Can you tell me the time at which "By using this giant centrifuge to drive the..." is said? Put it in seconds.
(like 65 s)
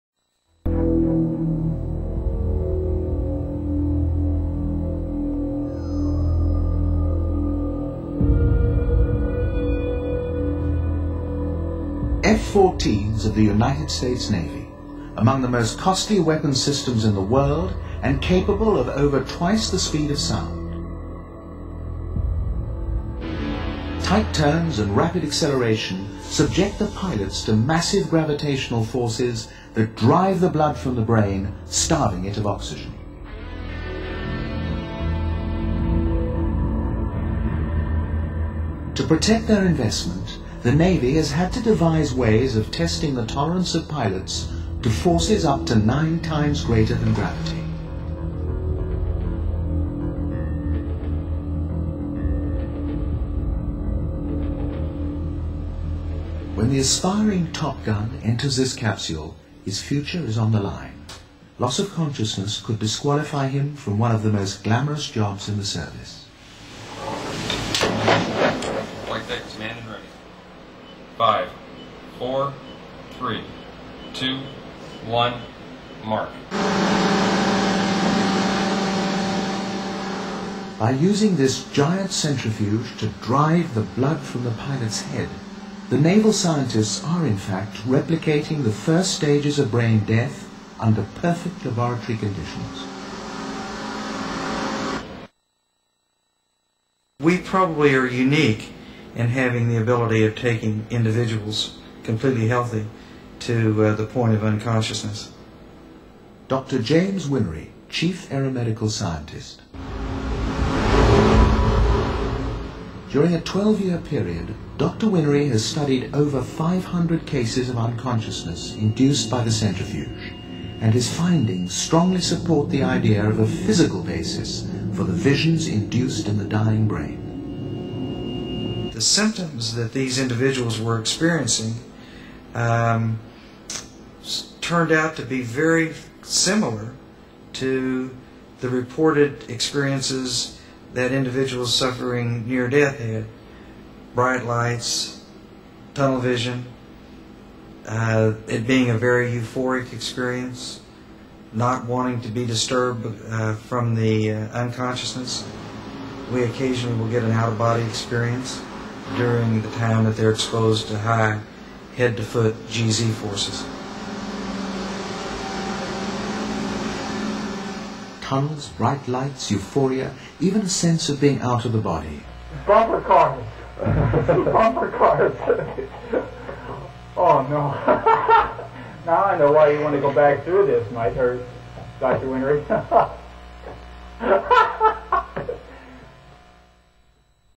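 80 s.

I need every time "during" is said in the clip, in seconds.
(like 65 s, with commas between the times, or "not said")
113 s, 159 s.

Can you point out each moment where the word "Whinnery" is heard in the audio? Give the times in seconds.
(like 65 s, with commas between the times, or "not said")
107 s, 115 s, 182 s.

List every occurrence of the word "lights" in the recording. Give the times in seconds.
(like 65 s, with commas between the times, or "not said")
144 s, 169 s.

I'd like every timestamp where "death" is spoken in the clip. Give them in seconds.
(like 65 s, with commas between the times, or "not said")
89 s, 142 s.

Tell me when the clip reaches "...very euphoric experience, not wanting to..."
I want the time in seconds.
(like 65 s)
148 s.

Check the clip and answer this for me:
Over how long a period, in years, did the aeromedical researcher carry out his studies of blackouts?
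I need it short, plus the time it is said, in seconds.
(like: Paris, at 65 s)
12 years, at 113 s.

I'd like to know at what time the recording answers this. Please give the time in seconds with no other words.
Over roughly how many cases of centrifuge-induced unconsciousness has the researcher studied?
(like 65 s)
116 s.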